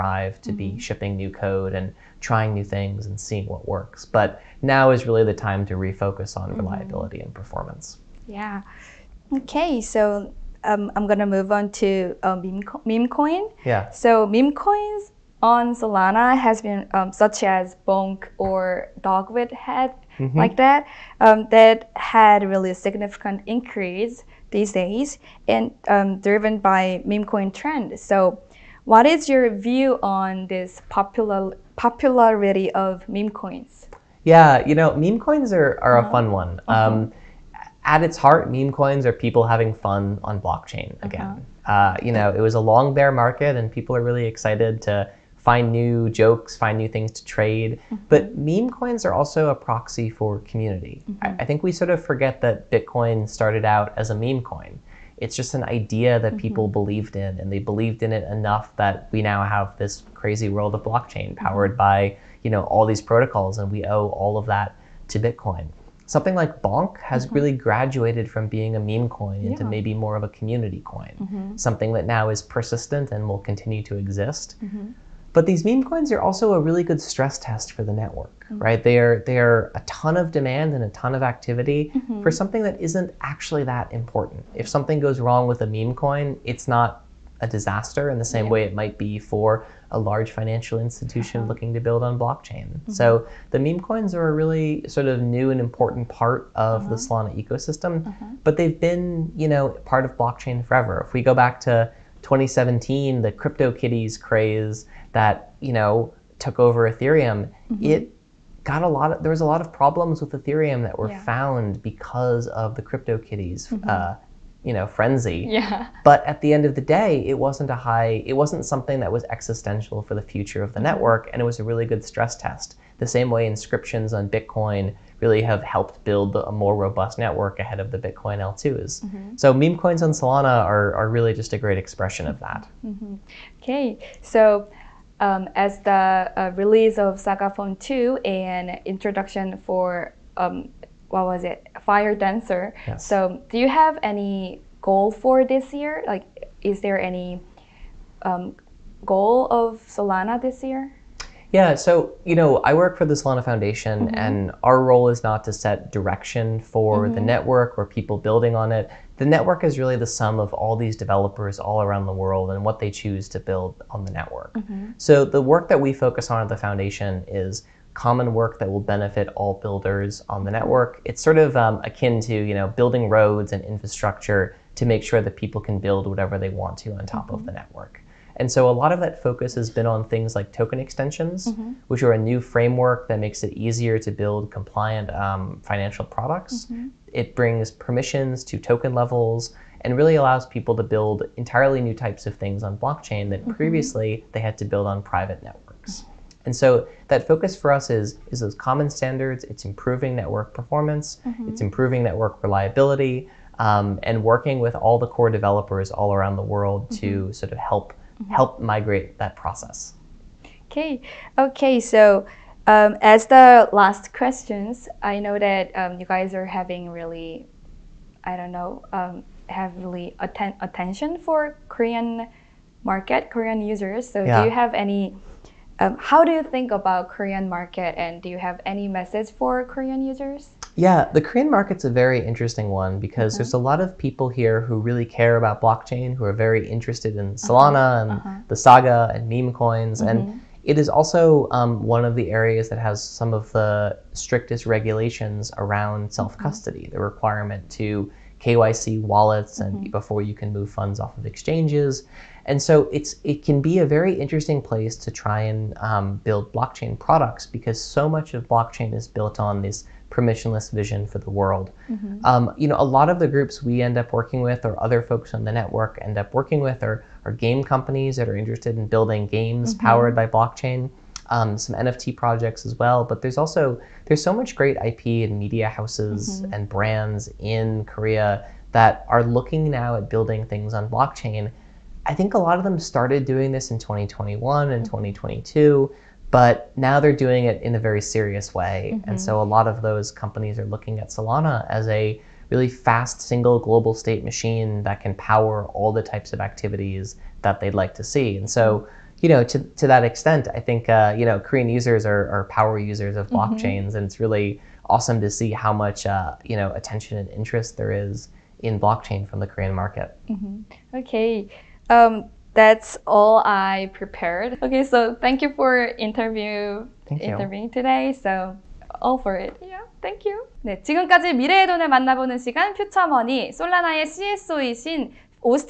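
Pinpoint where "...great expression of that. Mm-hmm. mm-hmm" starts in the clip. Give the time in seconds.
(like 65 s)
131 s.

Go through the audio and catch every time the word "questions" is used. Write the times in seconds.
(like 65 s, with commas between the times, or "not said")
214 s.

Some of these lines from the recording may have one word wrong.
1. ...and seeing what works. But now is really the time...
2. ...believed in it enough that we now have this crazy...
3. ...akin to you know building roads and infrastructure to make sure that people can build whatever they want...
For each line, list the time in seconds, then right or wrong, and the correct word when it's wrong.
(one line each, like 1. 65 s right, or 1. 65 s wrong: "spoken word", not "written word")
1. 3 s right
2. 57 s right
3. 171 s right.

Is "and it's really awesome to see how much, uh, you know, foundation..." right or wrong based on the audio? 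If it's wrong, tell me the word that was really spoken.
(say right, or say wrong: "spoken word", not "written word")
wrong: "attention", not "foundation".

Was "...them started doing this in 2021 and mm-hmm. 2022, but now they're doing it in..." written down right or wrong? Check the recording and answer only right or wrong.
right.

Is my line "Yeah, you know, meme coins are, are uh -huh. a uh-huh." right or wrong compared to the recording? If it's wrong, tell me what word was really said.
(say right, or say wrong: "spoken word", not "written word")
right.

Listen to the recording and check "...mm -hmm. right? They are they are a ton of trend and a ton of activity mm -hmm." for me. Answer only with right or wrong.
wrong.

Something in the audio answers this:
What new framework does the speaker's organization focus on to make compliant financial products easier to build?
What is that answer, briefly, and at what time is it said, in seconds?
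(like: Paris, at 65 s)
Token extensions, at 180 s.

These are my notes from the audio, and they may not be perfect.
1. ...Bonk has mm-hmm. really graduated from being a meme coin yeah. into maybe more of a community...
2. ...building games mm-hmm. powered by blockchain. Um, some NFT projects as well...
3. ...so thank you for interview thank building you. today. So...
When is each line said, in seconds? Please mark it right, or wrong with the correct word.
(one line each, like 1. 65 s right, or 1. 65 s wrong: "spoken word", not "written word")
1. 66 s right
2. 268 s right
3. 314 s wrong: "interviewing", not "building".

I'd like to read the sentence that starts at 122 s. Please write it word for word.
The same way inscriptions on Bitcoin really have helped build a more robust network ahead of the Bitcoin L2s.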